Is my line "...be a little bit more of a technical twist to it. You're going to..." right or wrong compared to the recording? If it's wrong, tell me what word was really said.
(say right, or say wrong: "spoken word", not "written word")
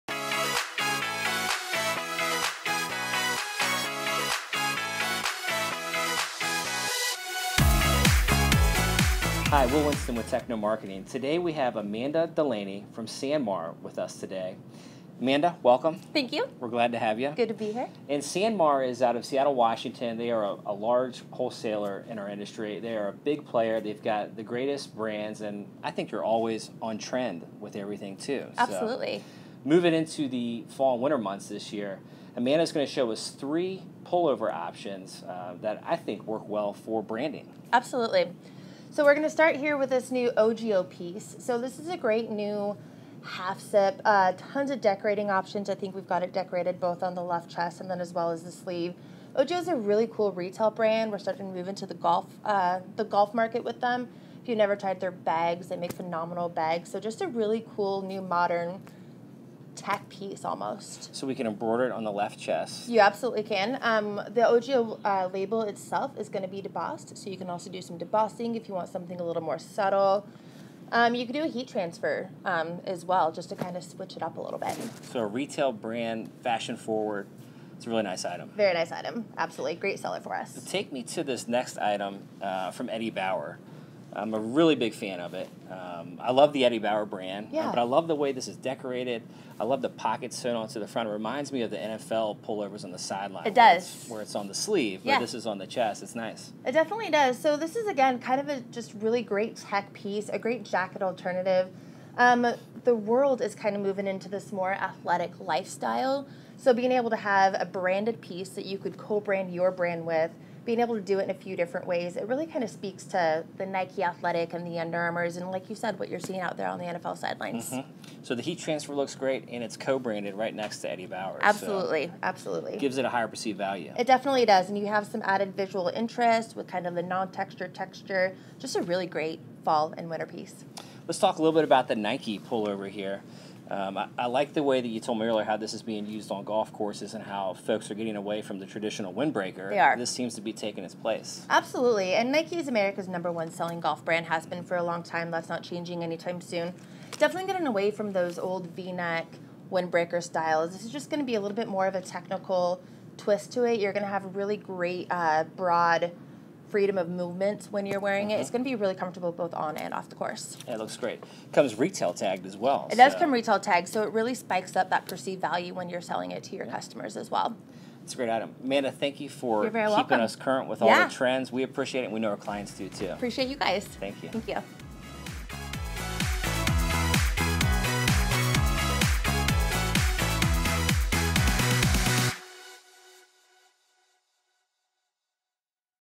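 right.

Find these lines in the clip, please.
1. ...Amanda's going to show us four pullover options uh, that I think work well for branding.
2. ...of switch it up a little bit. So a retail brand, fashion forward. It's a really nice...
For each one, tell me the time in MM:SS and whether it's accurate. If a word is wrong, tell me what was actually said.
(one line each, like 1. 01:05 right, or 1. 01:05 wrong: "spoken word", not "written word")
1. 00:32 wrong: "three", not "four"
2. 01:13 right.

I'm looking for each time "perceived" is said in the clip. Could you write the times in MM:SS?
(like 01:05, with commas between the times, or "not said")
02:03, 02:45.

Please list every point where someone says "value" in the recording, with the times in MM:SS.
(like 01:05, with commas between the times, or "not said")
02:03, 02:45.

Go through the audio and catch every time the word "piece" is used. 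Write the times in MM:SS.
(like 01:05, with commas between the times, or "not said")
00:40, 01:00, 01:39, 01:48, 02:10.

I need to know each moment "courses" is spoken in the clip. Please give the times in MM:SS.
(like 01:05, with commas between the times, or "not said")
02:16, 02:40.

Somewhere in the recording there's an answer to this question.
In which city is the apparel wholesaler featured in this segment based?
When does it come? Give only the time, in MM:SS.
00:19.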